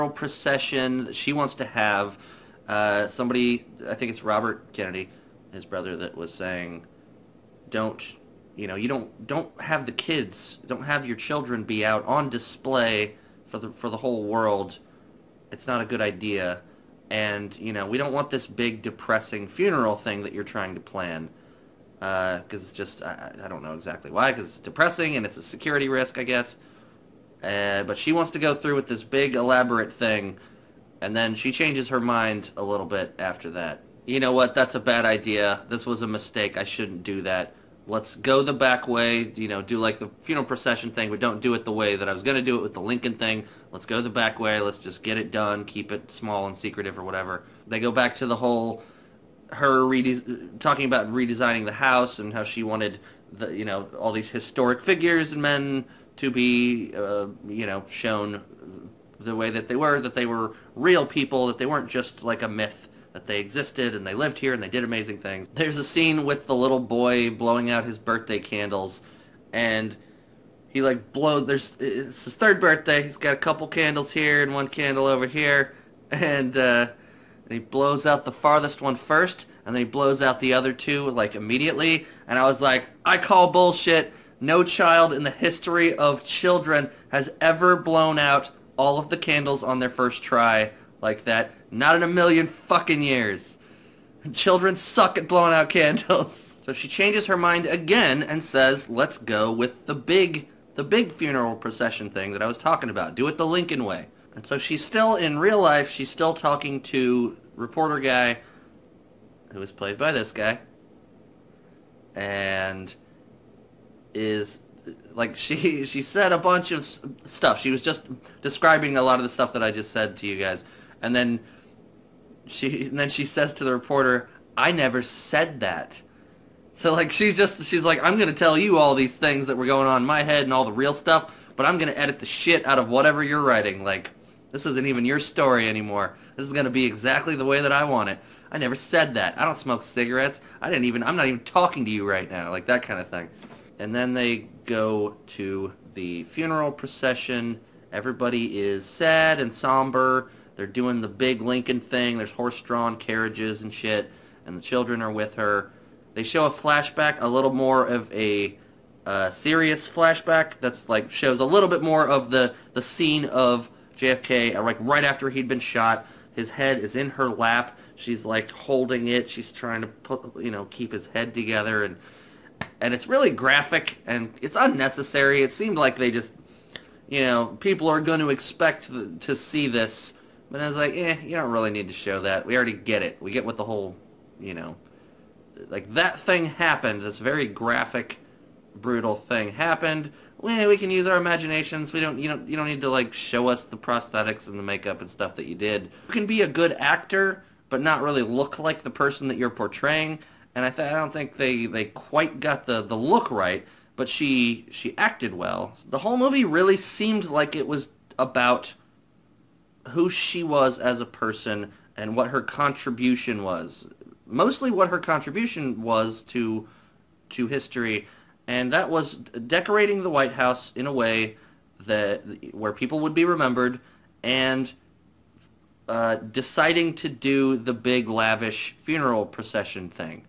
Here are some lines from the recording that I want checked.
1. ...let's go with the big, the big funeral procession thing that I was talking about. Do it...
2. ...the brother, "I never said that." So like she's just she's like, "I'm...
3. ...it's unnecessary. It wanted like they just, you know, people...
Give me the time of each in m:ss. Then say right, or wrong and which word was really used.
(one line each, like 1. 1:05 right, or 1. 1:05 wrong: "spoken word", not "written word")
1. 1:38 right
2. 2:03 wrong: "reporter", not "brother"
3. 2:54 wrong: "seemed", not "wanted".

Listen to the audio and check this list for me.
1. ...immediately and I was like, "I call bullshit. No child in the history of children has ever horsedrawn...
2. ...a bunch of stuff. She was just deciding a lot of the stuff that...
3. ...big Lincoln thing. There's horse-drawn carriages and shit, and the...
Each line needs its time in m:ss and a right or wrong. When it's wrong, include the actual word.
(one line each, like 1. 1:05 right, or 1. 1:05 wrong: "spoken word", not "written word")
1. 1:21 wrong: "blown", not "horsedrawn"
2. 1:56 wrong: "describing", not "deciding"
3. 2:31 right.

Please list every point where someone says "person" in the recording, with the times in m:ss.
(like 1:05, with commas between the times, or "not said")
3:18, 3:31.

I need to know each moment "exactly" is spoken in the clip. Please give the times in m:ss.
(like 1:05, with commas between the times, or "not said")
0:23, 2:16.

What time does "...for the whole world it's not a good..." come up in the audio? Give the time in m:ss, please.
0:13.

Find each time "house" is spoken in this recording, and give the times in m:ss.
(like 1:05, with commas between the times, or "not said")
0:51, 3:40.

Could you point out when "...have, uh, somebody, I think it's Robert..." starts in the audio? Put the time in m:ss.
0:01.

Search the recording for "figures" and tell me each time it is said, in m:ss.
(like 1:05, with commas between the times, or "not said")
0:54.